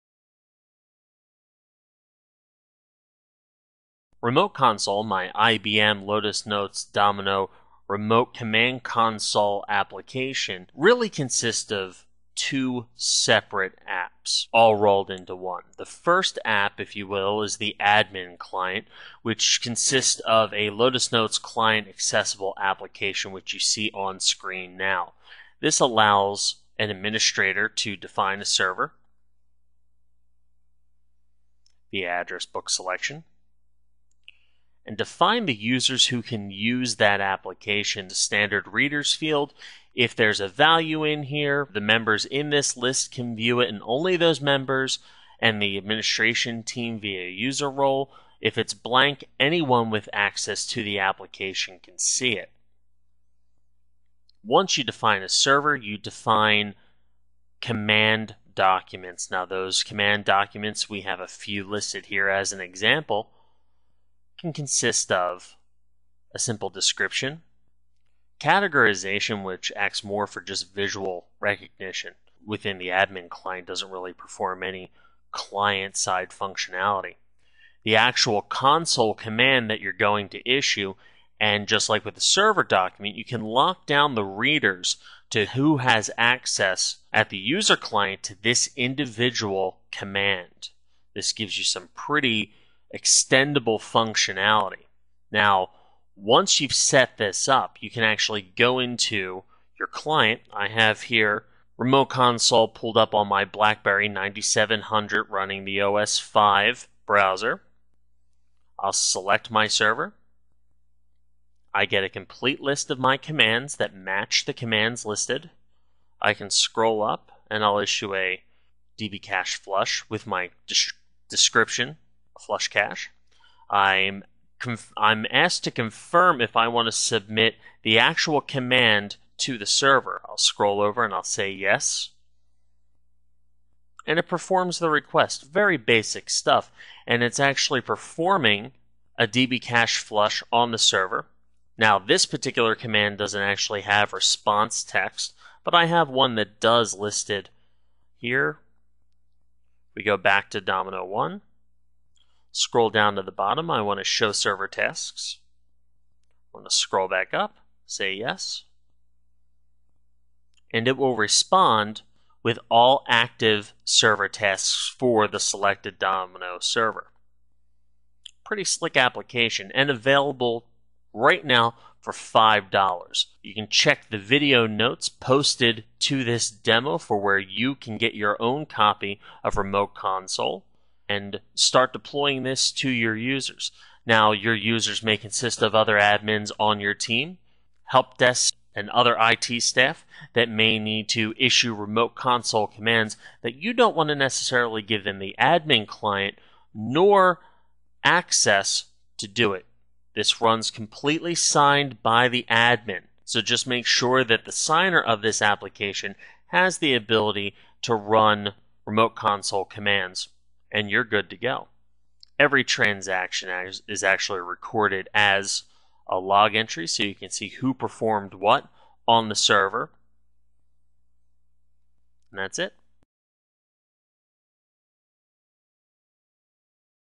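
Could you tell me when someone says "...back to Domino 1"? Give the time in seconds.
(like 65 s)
150 s.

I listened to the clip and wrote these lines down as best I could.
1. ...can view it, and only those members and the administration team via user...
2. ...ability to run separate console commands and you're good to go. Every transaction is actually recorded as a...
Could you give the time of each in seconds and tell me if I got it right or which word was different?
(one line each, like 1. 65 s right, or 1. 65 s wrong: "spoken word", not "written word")
1. 43 s right
2. 206 s wrong: "remote", not "separate".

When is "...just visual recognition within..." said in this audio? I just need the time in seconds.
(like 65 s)
70 s.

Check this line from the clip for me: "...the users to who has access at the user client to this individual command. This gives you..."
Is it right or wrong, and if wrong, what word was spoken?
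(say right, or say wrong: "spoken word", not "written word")
wrong: "readers", not "users".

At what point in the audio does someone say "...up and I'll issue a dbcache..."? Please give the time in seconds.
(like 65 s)
117 s.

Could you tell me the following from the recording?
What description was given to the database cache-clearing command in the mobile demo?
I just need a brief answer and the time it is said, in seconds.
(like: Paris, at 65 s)
Flush Cache, at 122 s.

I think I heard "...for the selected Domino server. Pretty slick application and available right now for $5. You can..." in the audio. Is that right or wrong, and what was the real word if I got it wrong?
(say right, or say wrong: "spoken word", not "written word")
right.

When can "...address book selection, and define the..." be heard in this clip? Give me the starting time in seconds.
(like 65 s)
32 s.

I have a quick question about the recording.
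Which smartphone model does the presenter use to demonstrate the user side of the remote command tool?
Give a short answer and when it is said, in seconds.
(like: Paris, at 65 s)
BlackBerry 9700, at 103 s.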